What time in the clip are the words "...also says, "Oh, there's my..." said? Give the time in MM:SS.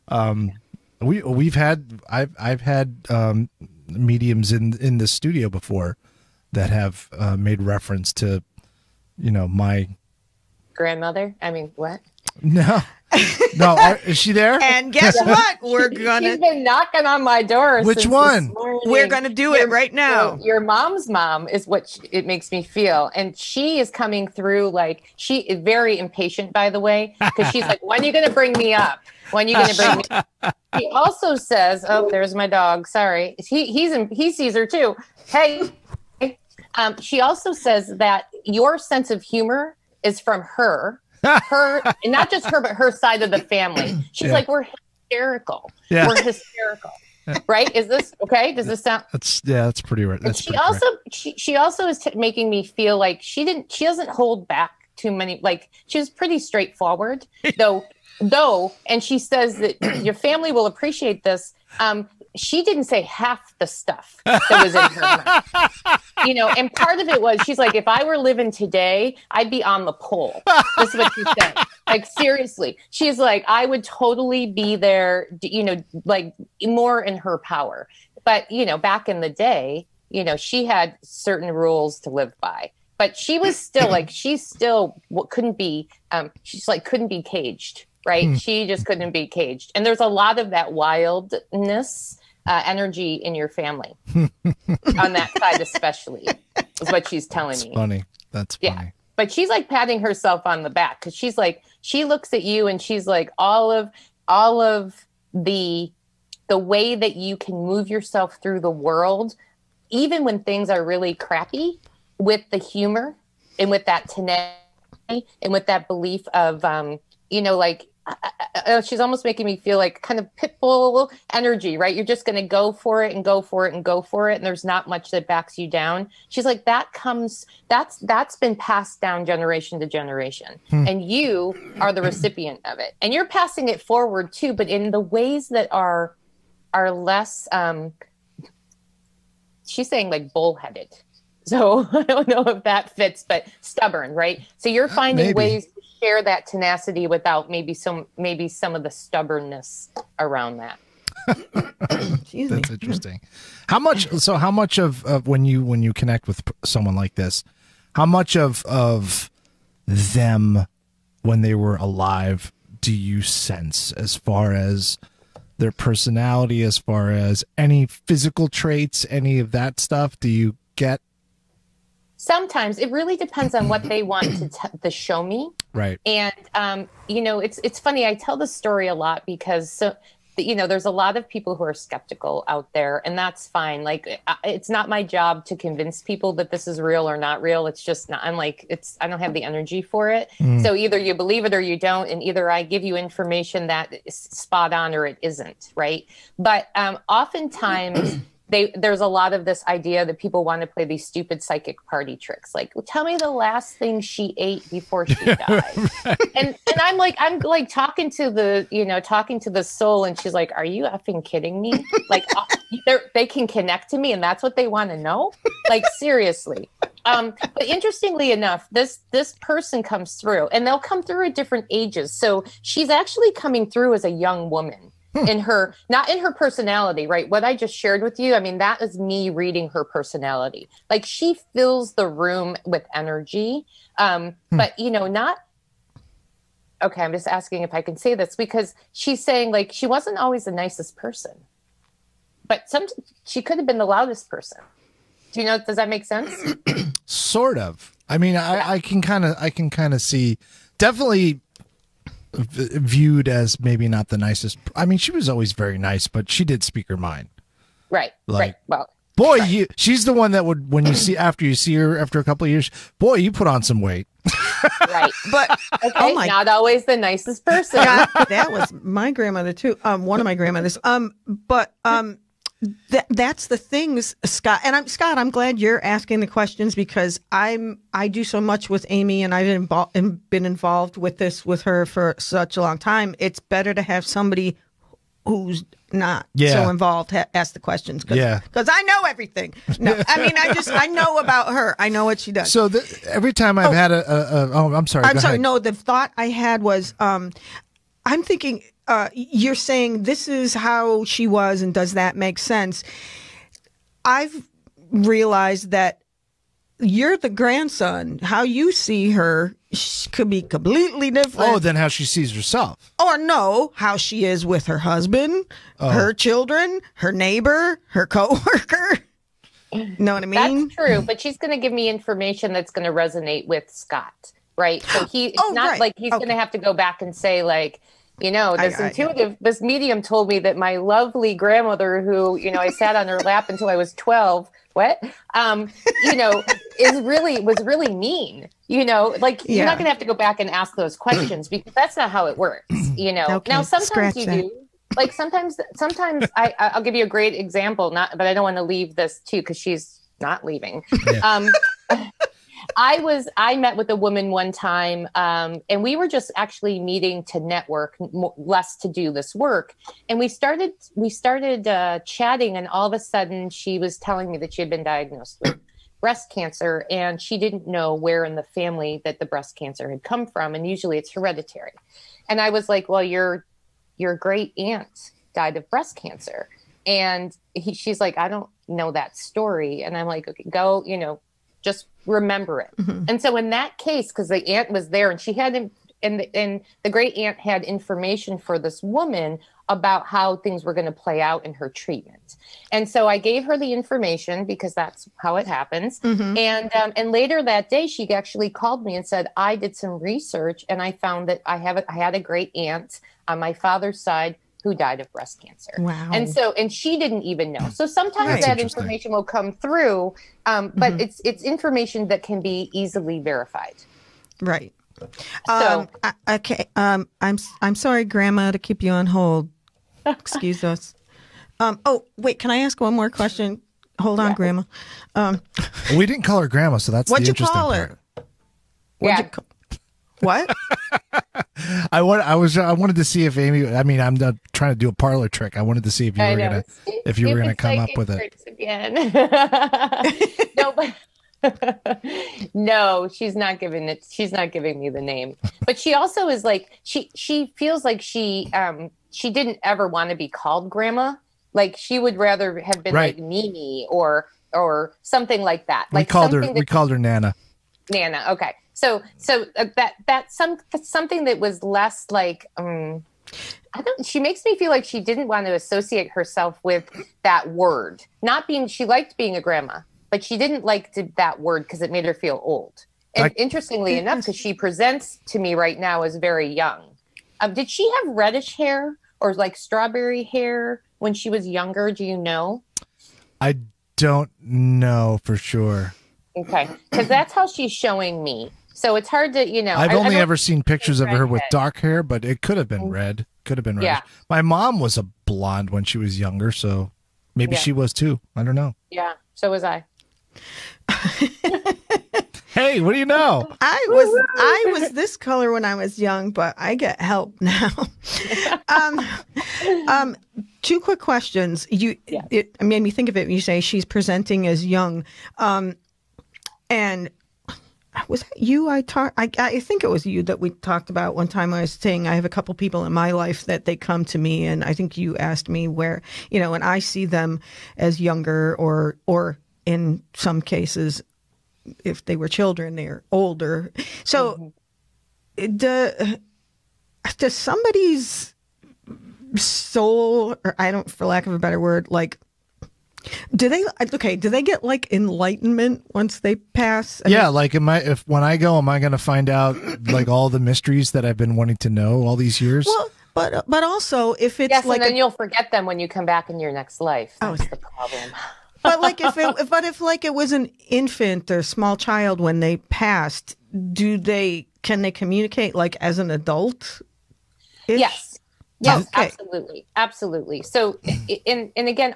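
00:30.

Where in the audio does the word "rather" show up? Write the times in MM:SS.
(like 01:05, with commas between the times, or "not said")
07:32.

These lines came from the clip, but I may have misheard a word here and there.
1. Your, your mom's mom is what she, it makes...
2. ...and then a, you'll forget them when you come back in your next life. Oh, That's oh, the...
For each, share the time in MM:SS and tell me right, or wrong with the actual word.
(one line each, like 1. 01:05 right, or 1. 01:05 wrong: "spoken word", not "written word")
1. 00:20 right
2. 09:14 right.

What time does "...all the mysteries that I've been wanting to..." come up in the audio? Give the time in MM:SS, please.
09:10.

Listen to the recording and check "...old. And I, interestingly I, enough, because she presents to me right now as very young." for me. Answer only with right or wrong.
right.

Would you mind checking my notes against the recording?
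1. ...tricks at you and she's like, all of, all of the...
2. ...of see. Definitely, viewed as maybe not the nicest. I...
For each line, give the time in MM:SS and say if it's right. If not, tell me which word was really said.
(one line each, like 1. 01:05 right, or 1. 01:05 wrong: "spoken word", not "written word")
1. 01:42 wrong: "looks", not "tricks"
2. 04:09 right.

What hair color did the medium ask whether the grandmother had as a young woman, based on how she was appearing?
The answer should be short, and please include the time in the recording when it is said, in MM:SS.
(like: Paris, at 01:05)
Strawberry, at 07:59.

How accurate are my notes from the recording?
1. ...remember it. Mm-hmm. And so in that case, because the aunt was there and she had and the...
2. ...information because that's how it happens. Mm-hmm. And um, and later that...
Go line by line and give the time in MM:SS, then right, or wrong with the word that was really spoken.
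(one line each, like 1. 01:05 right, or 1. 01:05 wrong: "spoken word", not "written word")
1. 06:22 right
2. 06:33 right.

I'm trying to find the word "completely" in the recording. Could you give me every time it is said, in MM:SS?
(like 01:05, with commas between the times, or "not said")
05:10.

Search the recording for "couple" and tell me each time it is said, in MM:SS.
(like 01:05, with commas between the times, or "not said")
04:22, 08:42.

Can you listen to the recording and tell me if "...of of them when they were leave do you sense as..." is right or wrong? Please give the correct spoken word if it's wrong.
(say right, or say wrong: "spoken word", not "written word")
wrong: "alive", not "leave".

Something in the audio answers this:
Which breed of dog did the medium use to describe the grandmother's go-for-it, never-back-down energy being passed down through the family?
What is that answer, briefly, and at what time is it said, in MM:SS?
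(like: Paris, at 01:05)
Pitbull, at 02:00.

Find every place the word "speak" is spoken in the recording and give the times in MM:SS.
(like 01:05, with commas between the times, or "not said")
04:16.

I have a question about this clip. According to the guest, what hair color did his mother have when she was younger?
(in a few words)
Blonde.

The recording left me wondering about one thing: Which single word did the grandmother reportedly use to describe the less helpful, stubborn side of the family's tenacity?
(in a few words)
Bullheaded.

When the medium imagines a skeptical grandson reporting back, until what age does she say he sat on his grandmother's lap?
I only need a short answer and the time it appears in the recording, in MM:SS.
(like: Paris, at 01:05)
12, at 05:33.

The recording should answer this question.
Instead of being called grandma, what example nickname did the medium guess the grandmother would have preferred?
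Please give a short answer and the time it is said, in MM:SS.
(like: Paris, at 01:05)
Mimi, at 07:33.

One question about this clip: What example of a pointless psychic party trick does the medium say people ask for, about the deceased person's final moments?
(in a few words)
The last thing she ate.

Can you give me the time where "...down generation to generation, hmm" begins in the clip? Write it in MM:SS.
02:09.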